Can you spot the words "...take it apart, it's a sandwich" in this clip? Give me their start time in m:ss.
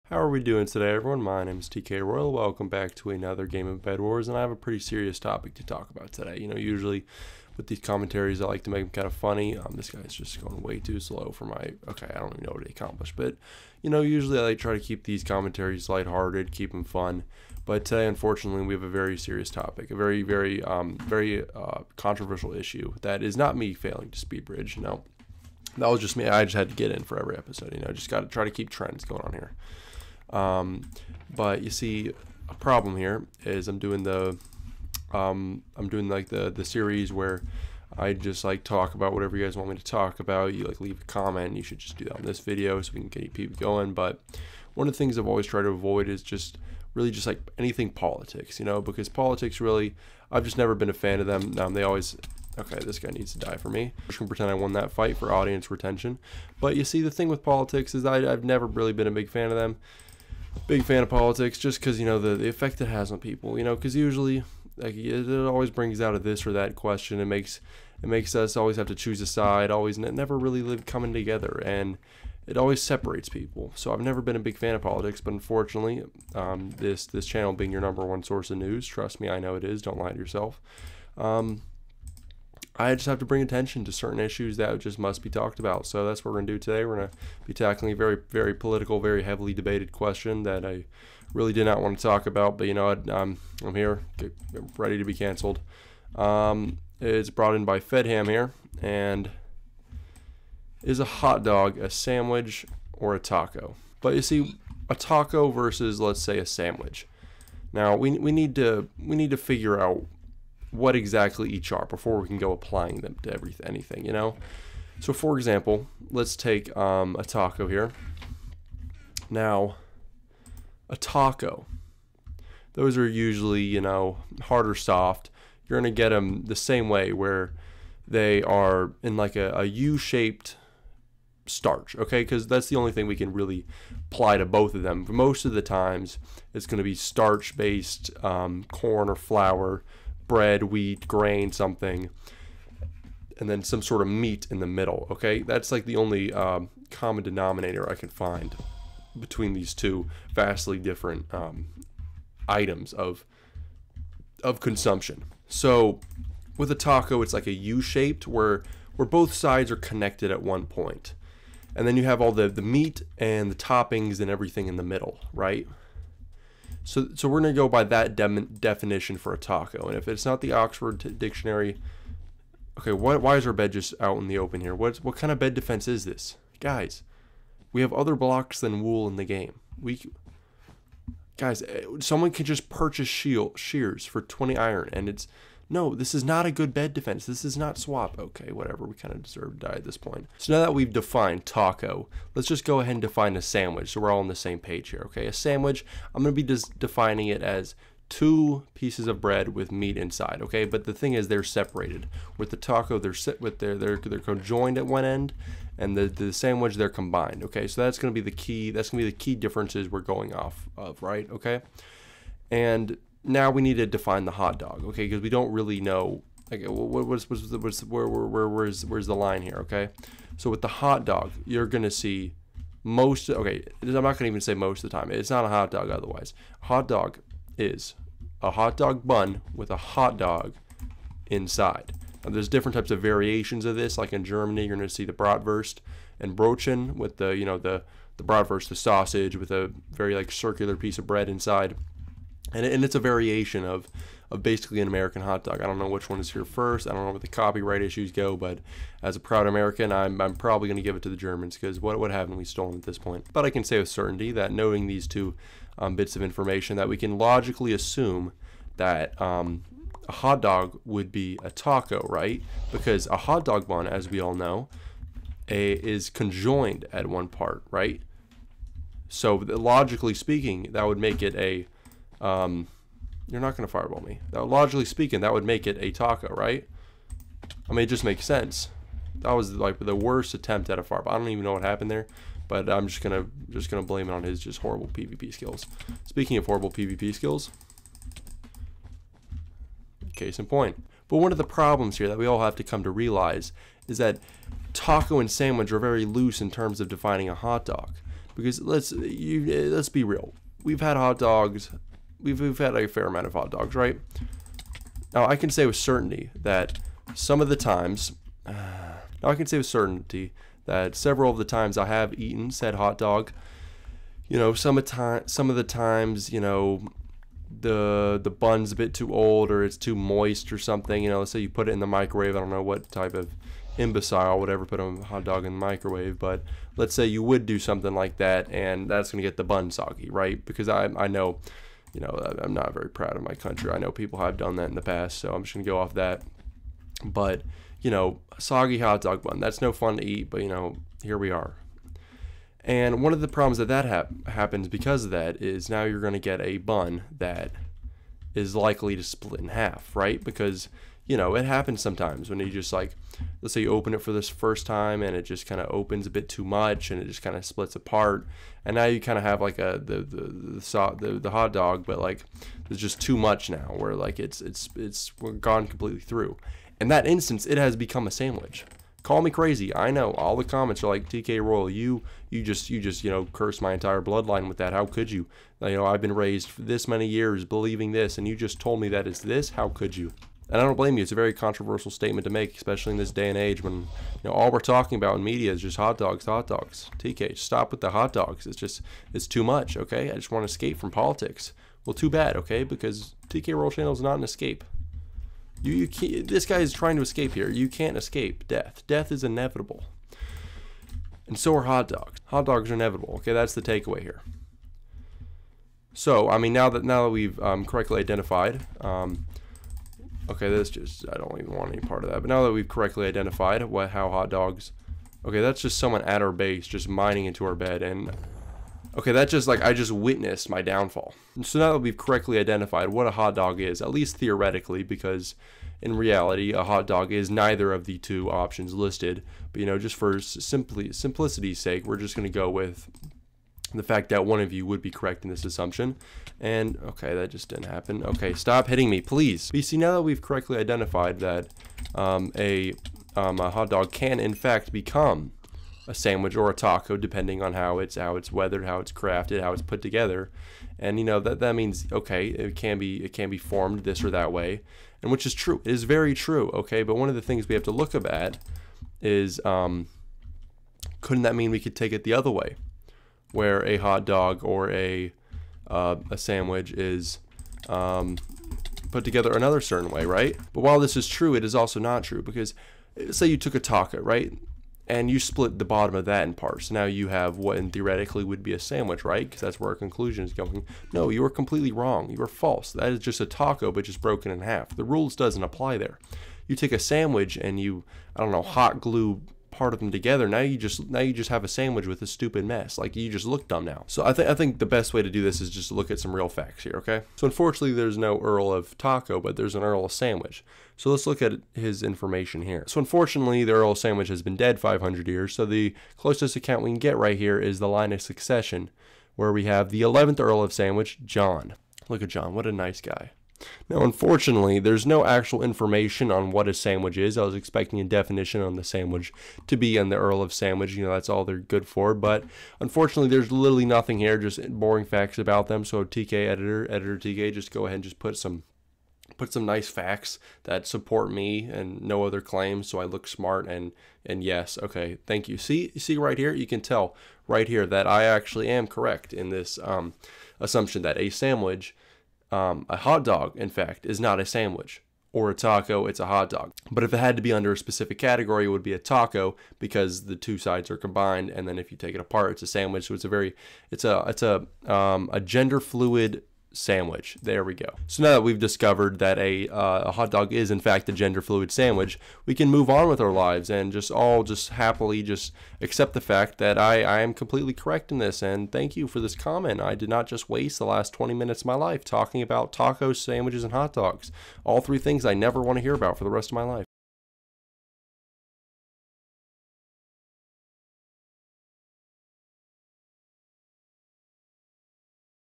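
9:11.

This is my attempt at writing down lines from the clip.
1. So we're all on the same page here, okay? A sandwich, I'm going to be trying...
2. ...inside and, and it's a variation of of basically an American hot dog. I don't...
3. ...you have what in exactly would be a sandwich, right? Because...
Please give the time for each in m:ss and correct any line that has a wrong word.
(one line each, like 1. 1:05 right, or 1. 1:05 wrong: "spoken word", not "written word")
1. 3:13 wrong: "defining", not "trying"
2. 4:01 right
3. 7:56 wrong: "theoretically", not "exactly".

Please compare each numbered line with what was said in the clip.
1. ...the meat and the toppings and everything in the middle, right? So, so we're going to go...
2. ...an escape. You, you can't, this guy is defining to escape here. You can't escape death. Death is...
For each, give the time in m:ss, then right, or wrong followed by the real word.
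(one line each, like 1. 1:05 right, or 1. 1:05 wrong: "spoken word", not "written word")
1. 2:42 right
2. 6:34 wrong: "trying", not "defining".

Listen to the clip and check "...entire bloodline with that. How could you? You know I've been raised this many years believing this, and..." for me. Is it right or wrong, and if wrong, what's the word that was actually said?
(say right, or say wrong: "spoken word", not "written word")
right.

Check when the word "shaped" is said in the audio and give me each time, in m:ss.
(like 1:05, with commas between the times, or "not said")
2:09, 2:37.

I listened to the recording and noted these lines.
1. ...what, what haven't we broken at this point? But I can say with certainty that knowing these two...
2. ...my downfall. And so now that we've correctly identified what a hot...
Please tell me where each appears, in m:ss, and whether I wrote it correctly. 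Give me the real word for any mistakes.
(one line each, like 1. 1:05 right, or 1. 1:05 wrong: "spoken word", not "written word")
1. 4:11 wrong: "stolen", not "broken"
2. 7:00 right.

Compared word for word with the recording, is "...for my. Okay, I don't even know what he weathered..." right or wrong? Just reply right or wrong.
wrong.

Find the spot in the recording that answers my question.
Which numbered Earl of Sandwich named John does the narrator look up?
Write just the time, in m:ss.
8:29.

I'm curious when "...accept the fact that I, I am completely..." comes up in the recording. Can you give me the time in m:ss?
9:25.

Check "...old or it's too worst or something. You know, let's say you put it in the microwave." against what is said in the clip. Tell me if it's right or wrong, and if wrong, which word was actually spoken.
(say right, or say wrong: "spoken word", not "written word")
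wrong: "moist", not "worst".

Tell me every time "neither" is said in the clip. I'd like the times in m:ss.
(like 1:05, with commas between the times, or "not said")
7:07.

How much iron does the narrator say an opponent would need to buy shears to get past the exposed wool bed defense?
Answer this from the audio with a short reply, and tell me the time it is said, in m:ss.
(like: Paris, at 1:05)
20 iron, at 3:04.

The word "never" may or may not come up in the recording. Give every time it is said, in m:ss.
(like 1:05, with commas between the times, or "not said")
0:50, 0:58, 1:09, 1:14, 9:35.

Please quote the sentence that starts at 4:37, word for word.
I mean, it just makes sense.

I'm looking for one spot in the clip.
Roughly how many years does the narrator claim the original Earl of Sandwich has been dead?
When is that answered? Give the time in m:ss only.
8:24.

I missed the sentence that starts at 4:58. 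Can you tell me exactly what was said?
Because let's you, let's be real, we've had hot dogs we've, we've had a fair amount of hot dogs, right?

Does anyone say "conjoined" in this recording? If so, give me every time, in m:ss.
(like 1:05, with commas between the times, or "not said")
3:24, 4:26.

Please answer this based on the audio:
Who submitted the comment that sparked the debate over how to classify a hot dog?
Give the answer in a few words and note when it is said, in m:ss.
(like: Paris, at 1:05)
FedHam, at 1:37.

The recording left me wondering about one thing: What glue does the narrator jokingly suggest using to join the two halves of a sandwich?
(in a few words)
hot glue.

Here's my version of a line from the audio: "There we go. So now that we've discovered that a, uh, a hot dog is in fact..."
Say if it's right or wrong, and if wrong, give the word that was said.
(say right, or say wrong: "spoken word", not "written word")
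right.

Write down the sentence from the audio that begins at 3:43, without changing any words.
Okay, I'm not gonna even say most of the time.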